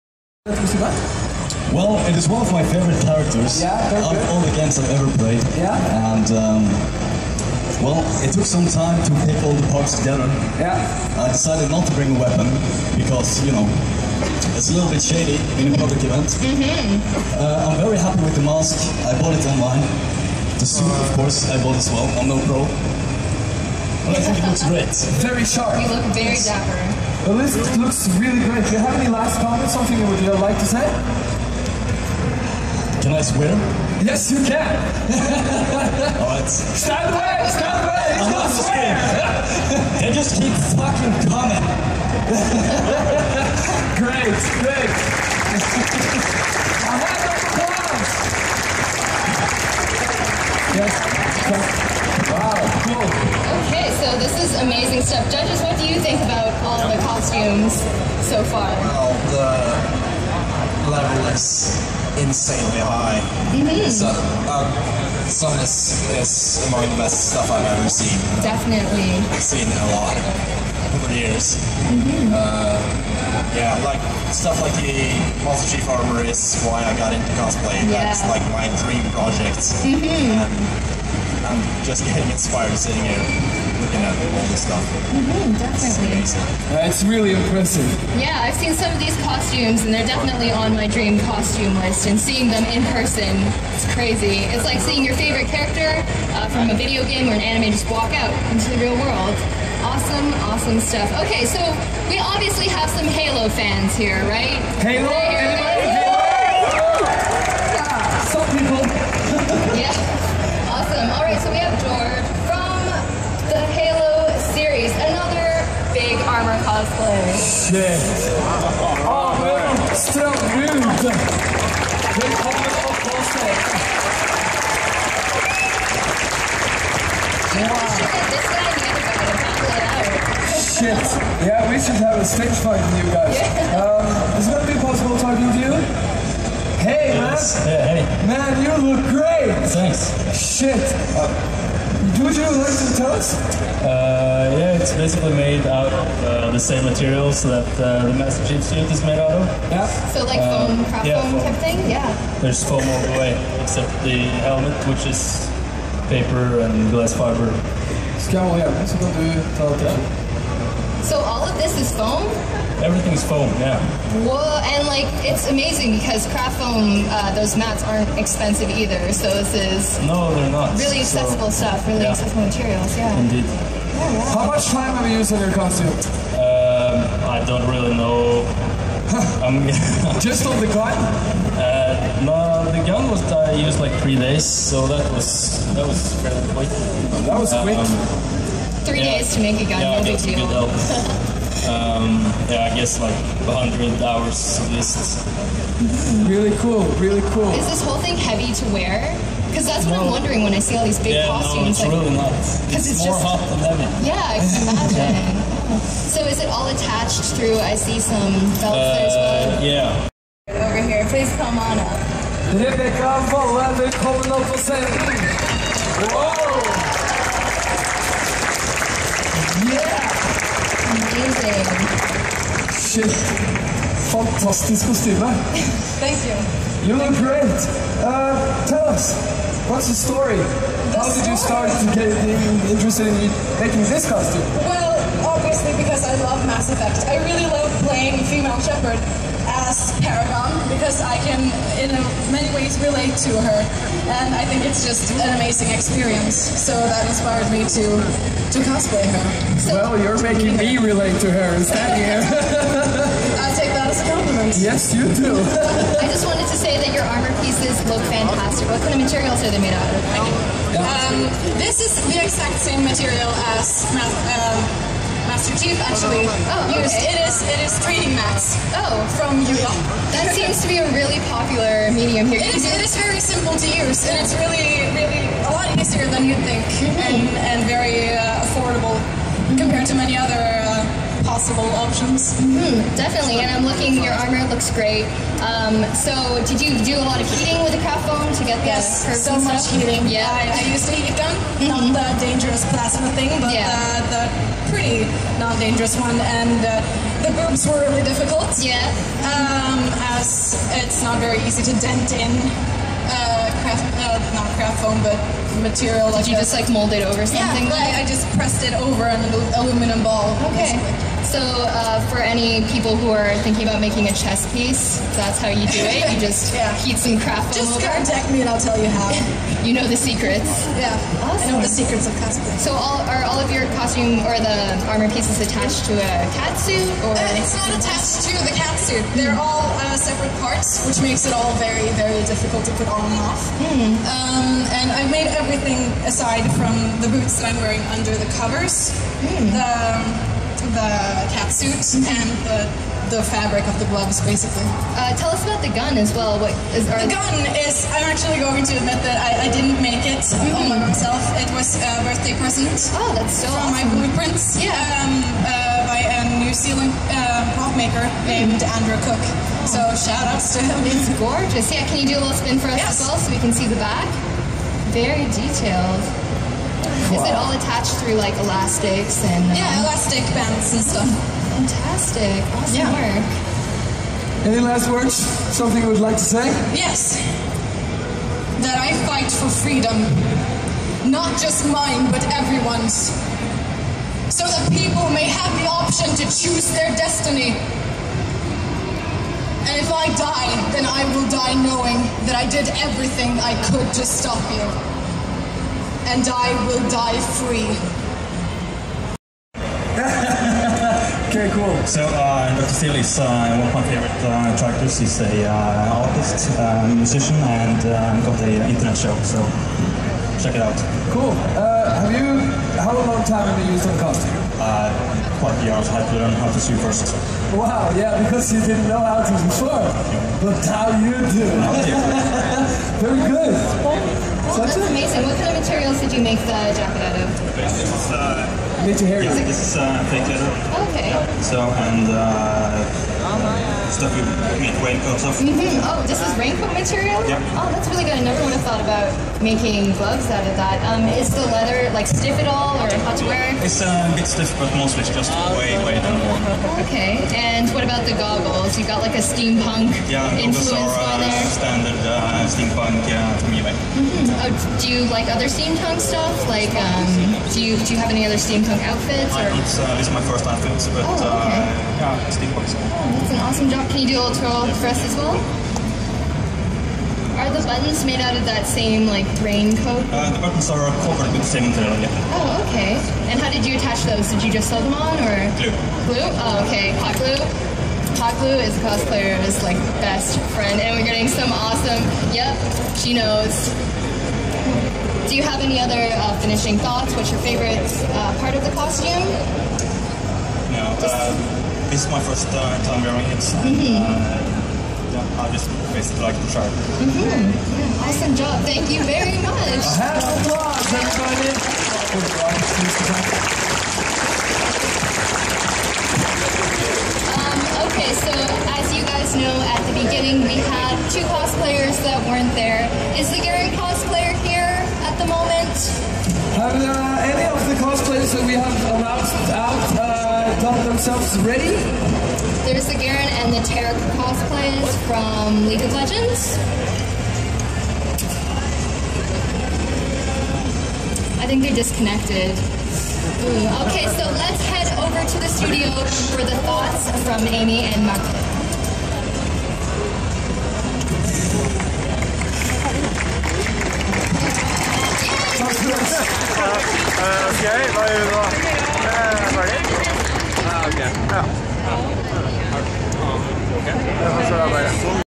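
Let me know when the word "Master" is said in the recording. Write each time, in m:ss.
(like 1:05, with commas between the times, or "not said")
1:15, 2:28, 4:25.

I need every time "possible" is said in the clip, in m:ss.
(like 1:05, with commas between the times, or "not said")
2:14, 4:41.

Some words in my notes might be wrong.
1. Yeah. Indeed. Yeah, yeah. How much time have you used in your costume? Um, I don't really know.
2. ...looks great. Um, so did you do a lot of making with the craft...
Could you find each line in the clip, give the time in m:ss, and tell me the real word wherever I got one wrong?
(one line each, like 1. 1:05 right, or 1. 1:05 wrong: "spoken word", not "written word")
1. 2:52 right
2. 4:44 wrong: "heating", not "making".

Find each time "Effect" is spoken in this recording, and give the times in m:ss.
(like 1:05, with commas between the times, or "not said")
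3:56.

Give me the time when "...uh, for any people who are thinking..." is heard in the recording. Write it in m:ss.
5:11.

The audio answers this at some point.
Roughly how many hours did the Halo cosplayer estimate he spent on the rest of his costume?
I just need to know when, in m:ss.
3:13.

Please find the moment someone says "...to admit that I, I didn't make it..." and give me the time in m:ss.
5:48.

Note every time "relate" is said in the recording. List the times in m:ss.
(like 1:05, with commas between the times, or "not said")
4:02, 4:10.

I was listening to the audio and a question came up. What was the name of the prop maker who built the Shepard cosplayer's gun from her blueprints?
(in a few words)
Andrew Cook.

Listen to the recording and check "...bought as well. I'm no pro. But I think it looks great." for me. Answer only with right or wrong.
right.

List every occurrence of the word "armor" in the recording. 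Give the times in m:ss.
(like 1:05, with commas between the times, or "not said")
1:15, 4:17, 4:44, 5:24.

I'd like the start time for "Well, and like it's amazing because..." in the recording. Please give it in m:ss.
2:44.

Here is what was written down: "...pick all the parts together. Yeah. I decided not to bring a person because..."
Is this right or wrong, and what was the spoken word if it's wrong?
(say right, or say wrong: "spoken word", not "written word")
wrong: "weapon", not "person".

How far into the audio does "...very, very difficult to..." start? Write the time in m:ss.
5:31.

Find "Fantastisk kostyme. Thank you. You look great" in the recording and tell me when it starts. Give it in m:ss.
3:44.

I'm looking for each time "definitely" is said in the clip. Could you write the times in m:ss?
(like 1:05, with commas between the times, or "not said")
1:08, 1:30, 4:42.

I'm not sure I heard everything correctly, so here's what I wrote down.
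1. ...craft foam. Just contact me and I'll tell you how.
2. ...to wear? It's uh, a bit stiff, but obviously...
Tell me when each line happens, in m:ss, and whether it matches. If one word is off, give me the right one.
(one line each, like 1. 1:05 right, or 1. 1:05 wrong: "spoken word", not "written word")
1. 5:17 right
2. 7:23 wrong: "mostly", not "obviously".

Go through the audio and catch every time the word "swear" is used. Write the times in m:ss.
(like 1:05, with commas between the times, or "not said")
0:33, 0:38.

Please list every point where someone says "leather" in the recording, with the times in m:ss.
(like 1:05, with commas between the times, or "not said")
7:10, 7:21.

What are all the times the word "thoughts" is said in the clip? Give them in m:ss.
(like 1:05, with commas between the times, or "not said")
7:18, 8:06, 8:56.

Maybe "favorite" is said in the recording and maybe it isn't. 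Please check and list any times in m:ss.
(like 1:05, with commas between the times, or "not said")
0:02, 1:35, 6:43, 8:07.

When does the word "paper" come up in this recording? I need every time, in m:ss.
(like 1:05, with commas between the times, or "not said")
2:36.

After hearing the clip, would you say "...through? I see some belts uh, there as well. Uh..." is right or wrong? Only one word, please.
right.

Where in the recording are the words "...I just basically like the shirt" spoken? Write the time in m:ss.
8:15.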